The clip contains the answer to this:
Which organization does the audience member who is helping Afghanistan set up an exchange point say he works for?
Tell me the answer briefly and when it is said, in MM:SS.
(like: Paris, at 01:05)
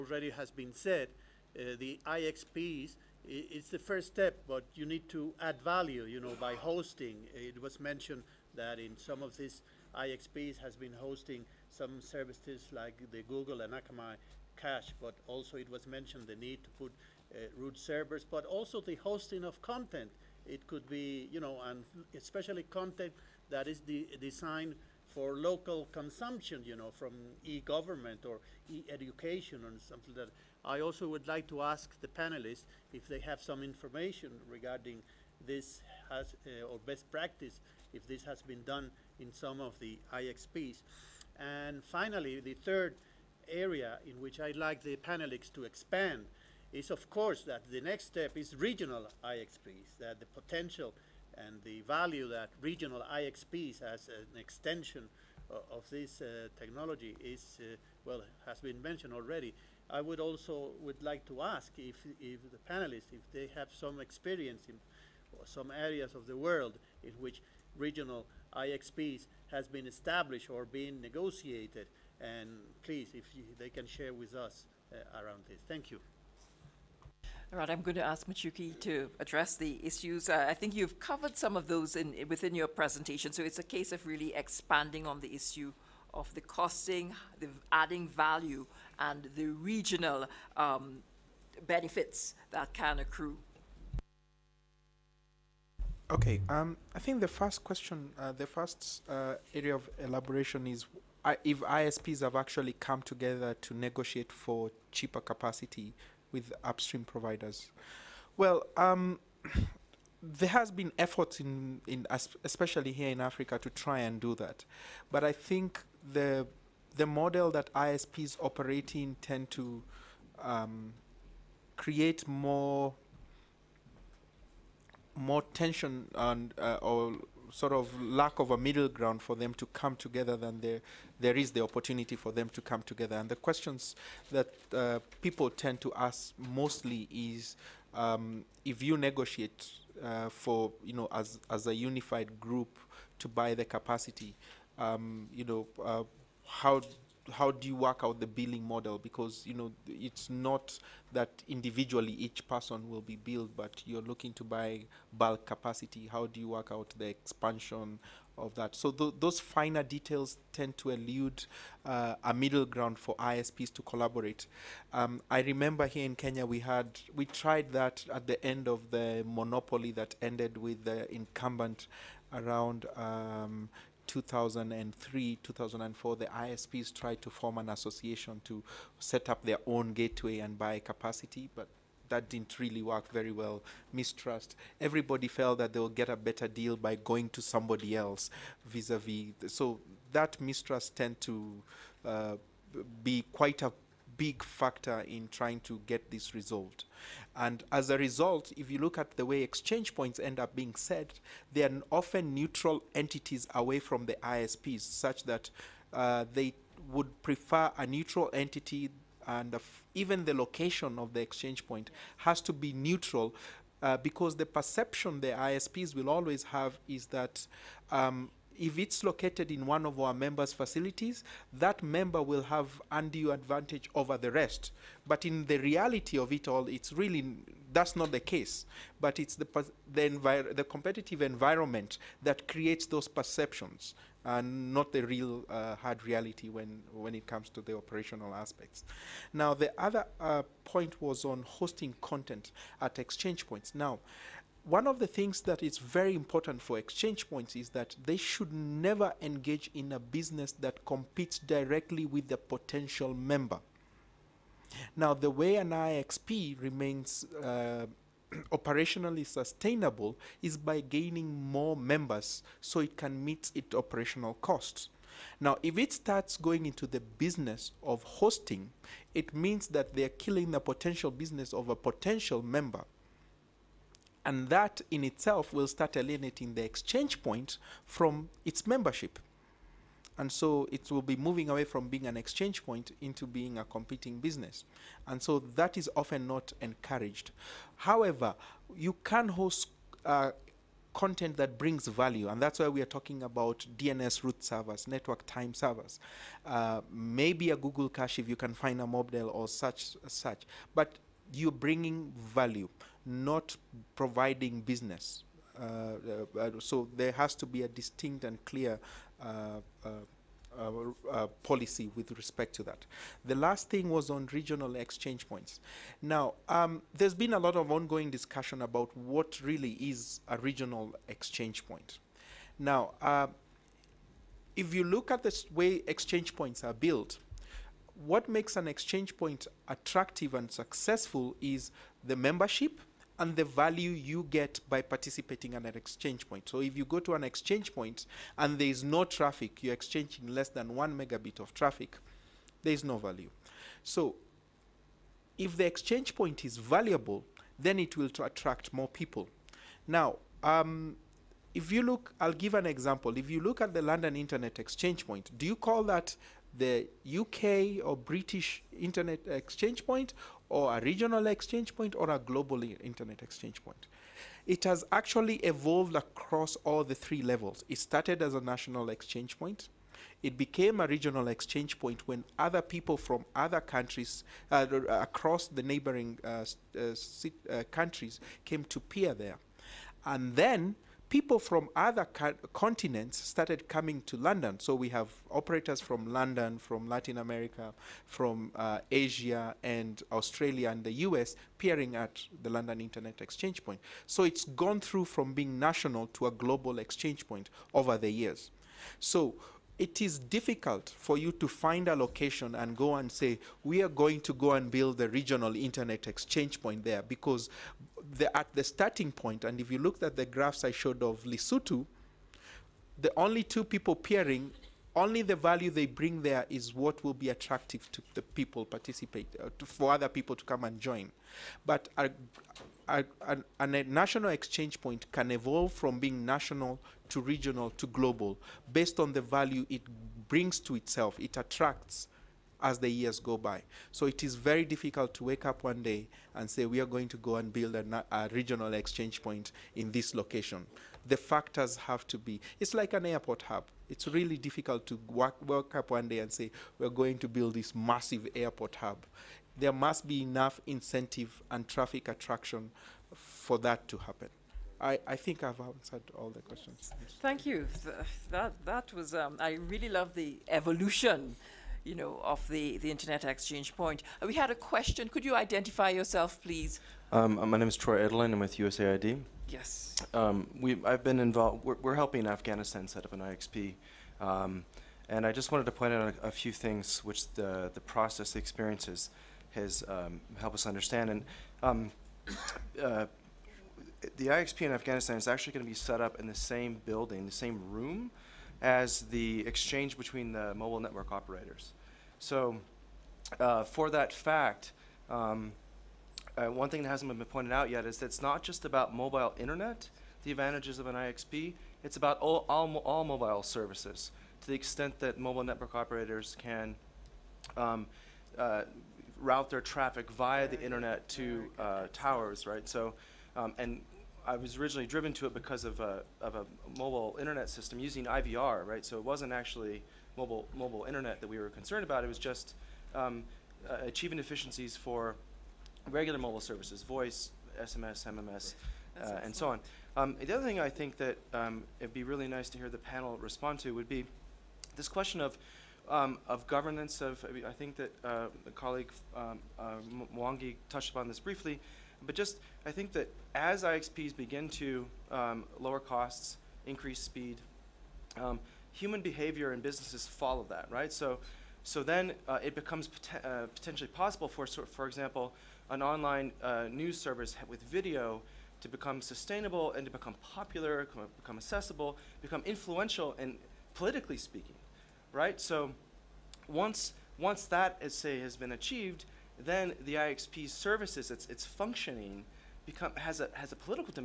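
USAID, at 07:48.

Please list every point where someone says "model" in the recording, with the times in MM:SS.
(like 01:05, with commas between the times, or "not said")
01:57, 02:28.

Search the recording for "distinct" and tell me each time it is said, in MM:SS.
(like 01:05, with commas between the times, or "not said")
05:07.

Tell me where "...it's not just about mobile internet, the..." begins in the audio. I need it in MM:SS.
08:18.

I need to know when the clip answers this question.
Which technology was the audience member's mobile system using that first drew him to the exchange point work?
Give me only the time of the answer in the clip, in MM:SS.
08:38.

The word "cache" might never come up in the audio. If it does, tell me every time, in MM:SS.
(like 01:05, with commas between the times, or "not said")
00:14, 04:57.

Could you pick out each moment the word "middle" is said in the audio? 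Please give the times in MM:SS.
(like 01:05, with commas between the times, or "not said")
02:08, 02:42.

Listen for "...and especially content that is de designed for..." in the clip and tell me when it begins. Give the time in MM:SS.
00:21.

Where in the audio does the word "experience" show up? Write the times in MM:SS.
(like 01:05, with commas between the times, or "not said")
01:04, 07:58.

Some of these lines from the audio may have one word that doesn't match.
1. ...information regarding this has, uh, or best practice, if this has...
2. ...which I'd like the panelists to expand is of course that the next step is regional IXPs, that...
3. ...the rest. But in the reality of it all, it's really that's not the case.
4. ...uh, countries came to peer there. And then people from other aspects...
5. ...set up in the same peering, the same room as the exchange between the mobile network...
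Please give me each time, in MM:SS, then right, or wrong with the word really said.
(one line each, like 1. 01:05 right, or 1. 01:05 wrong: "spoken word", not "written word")
1. 00:33 right
2. 00:44 right
3. 03:44 right
4. 06:17 wrong: "continents", not "aspects"
5. 08:05 wrong: "building", not "peering".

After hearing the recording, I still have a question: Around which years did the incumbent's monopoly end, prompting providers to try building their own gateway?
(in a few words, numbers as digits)
2003, 2004.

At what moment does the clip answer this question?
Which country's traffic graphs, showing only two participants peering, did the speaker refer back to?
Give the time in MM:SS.
06:51.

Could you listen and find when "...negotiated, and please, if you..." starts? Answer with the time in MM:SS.
01:11.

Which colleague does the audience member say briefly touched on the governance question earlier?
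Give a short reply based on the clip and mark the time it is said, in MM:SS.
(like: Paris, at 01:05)
Mwangi, at 09:00.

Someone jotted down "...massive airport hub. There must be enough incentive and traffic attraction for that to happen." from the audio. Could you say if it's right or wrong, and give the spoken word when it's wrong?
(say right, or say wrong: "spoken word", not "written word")
right.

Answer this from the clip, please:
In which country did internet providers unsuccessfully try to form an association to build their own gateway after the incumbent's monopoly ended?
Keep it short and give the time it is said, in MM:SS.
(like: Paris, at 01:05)
Kenya, at 02:46.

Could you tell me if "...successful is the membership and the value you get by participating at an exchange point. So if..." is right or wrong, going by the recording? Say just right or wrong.
right.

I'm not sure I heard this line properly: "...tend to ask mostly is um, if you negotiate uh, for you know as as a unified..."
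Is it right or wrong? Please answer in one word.
right.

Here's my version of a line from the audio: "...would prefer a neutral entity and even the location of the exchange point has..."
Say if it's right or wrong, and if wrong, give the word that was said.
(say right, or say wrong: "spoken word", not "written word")
right.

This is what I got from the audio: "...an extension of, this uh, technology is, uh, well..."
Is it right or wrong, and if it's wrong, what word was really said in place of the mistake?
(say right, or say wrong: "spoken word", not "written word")
right.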